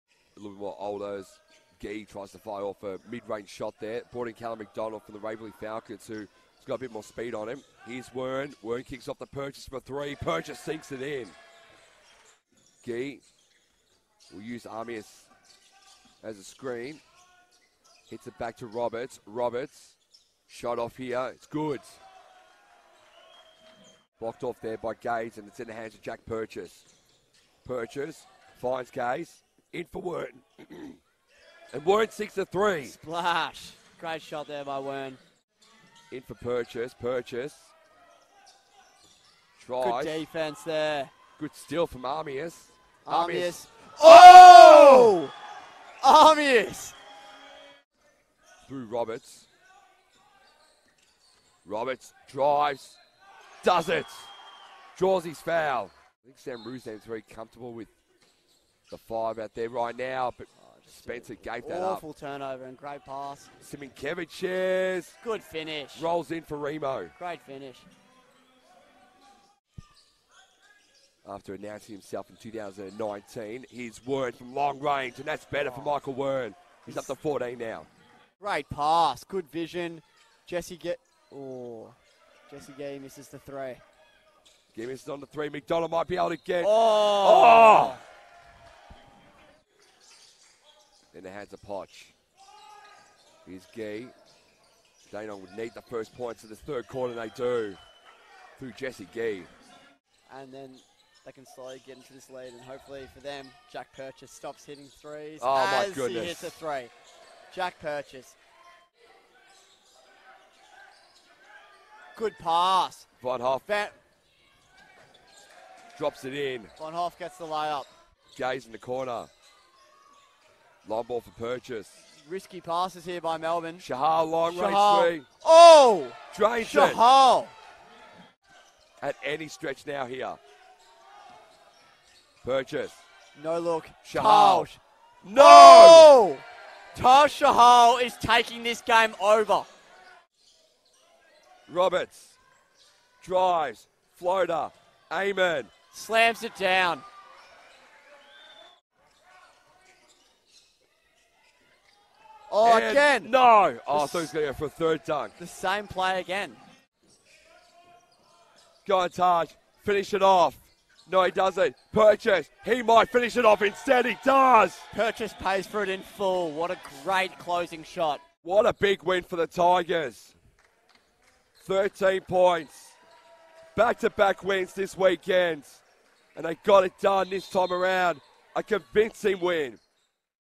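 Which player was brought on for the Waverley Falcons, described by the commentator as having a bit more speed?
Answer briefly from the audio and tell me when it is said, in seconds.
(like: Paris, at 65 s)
Callum McDonald, at 4 s.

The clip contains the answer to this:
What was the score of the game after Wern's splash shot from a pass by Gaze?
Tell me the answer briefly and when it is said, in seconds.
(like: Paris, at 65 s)
6 to 3, at 32 s.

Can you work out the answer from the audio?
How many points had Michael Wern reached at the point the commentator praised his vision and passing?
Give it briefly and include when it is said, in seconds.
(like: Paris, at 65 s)
14, at 77 s.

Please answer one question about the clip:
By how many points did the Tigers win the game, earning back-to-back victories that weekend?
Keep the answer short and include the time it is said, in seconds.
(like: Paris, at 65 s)
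13, at 171 s.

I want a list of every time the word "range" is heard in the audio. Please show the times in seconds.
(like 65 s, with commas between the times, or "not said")
3 s, 74 s, 125 s.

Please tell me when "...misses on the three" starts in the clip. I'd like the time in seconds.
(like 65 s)
84 s.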